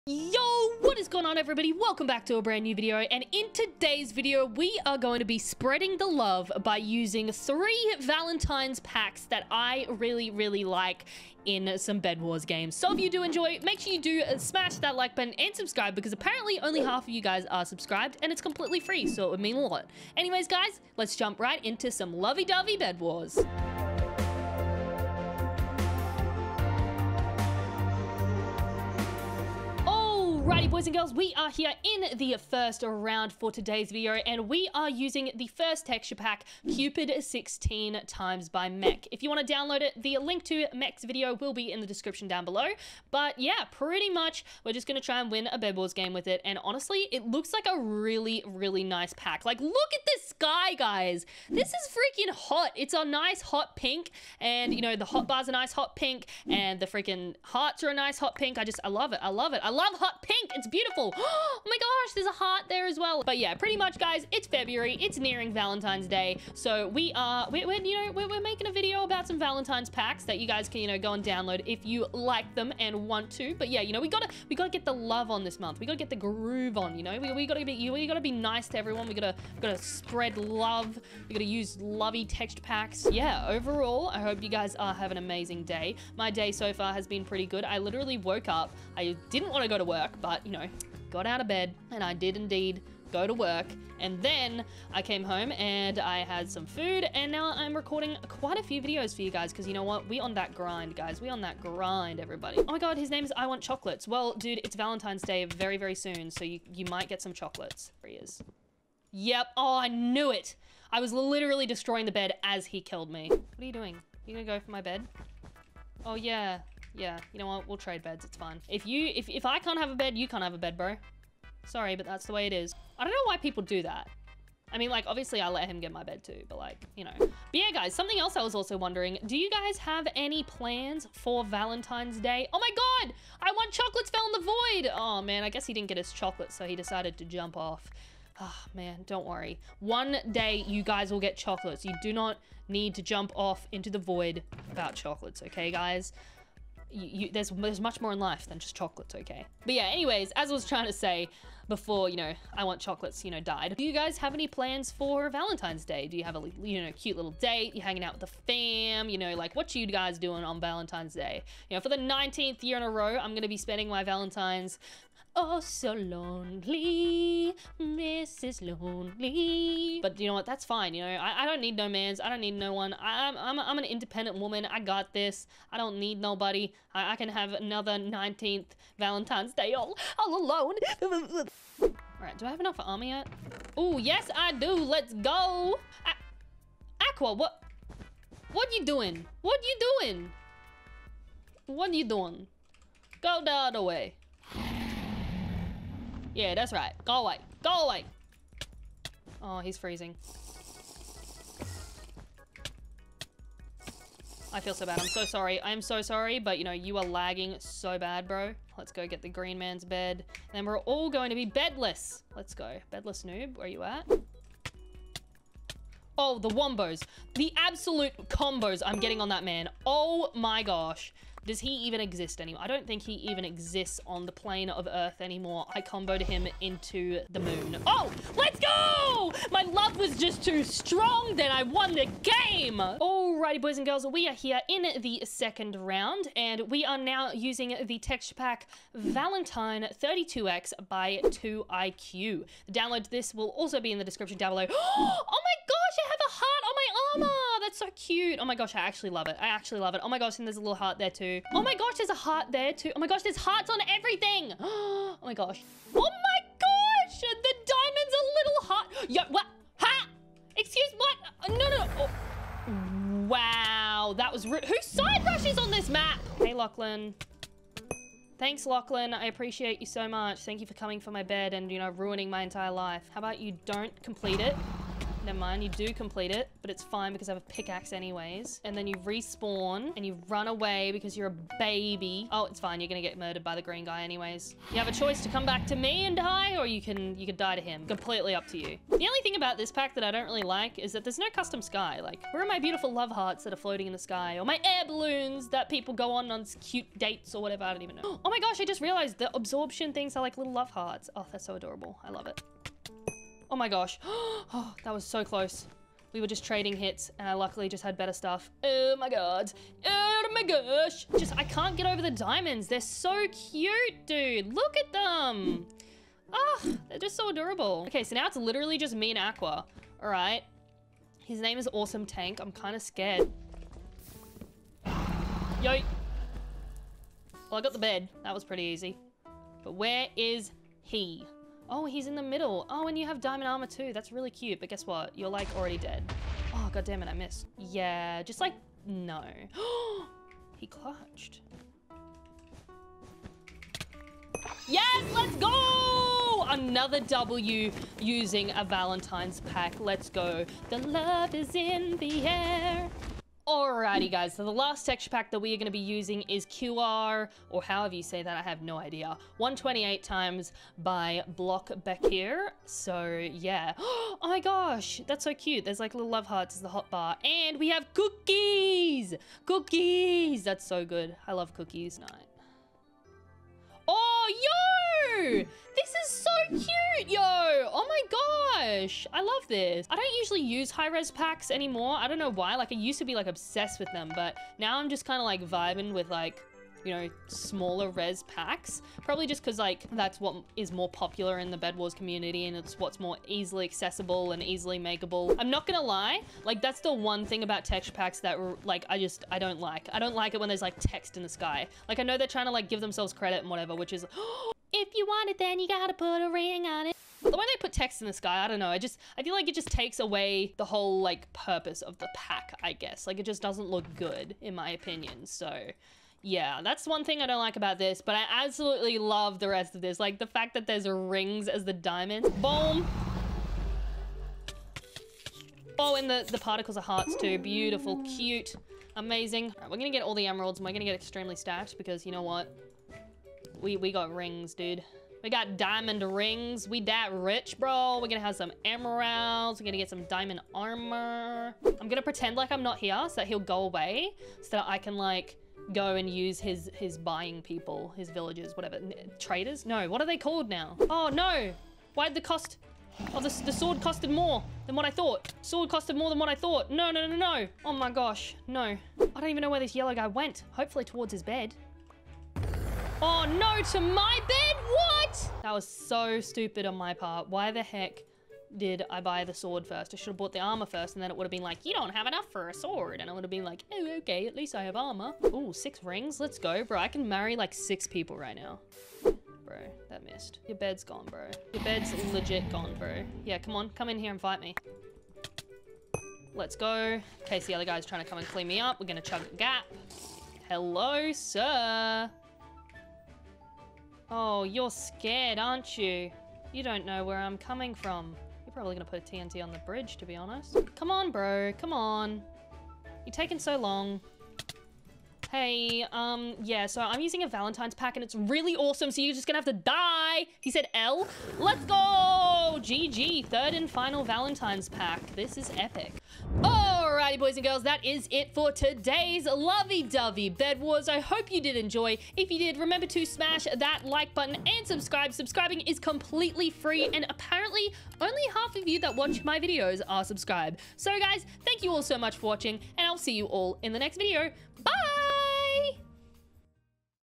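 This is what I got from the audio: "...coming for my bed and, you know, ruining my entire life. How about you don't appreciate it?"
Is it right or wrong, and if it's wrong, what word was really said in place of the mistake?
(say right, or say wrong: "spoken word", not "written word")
wrong: "complete", not "appreciate".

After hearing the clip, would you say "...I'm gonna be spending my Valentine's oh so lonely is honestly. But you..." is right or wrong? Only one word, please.
wrong.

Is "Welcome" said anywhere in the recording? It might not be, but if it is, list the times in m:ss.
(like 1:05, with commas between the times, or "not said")
0:01.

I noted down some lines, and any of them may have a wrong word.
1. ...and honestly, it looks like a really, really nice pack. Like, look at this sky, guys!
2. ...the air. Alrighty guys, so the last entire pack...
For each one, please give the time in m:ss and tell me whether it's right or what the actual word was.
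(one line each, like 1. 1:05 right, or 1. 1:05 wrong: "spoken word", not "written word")
1. 0:46 right
2. 5:51 wrong: "texture", not "entire".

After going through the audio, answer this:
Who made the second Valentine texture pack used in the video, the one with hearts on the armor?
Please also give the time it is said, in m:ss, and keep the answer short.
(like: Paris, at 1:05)
2IQ, at 4:01.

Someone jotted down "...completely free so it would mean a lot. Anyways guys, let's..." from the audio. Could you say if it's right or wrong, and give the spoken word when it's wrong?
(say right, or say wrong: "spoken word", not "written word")
right.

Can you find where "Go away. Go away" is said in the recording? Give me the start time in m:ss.
3:17.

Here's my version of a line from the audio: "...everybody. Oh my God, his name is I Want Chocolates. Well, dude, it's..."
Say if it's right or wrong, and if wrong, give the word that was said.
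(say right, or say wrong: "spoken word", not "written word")
right.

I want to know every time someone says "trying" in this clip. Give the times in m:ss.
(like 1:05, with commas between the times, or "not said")
2:30, 6:42, 8:07.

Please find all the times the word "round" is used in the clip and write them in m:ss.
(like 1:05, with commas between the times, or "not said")
0:32, 3:55.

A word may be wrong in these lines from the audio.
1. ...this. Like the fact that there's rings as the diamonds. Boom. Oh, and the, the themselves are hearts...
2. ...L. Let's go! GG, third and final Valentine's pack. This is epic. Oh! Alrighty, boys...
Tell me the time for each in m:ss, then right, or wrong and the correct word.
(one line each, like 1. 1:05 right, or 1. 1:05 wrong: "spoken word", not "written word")
1. 6:59 wrong: "particles", not "themselves"
2. 8:30 right.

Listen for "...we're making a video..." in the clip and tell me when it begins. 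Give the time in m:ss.
1:08.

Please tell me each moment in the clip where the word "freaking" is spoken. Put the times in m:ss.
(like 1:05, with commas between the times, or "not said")
0:51, 0:56.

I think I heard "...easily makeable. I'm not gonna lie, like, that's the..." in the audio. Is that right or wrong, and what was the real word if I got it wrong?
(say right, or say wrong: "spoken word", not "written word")
right.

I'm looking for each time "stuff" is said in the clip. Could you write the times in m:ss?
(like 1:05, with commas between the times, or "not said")
5:08.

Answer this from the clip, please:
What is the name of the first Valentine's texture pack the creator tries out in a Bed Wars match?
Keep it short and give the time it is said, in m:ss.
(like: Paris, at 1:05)
Cupid 16x, at 0:36.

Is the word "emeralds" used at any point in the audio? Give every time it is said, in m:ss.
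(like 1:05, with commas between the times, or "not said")
7:10, 7:18.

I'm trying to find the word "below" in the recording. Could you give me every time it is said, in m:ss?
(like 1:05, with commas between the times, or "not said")
0:42, 4:04.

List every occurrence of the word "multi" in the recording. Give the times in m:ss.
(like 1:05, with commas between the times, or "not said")
not said.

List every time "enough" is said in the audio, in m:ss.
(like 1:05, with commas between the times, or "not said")
3:02, 7:52.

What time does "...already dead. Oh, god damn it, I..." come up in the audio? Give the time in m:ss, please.
5:35.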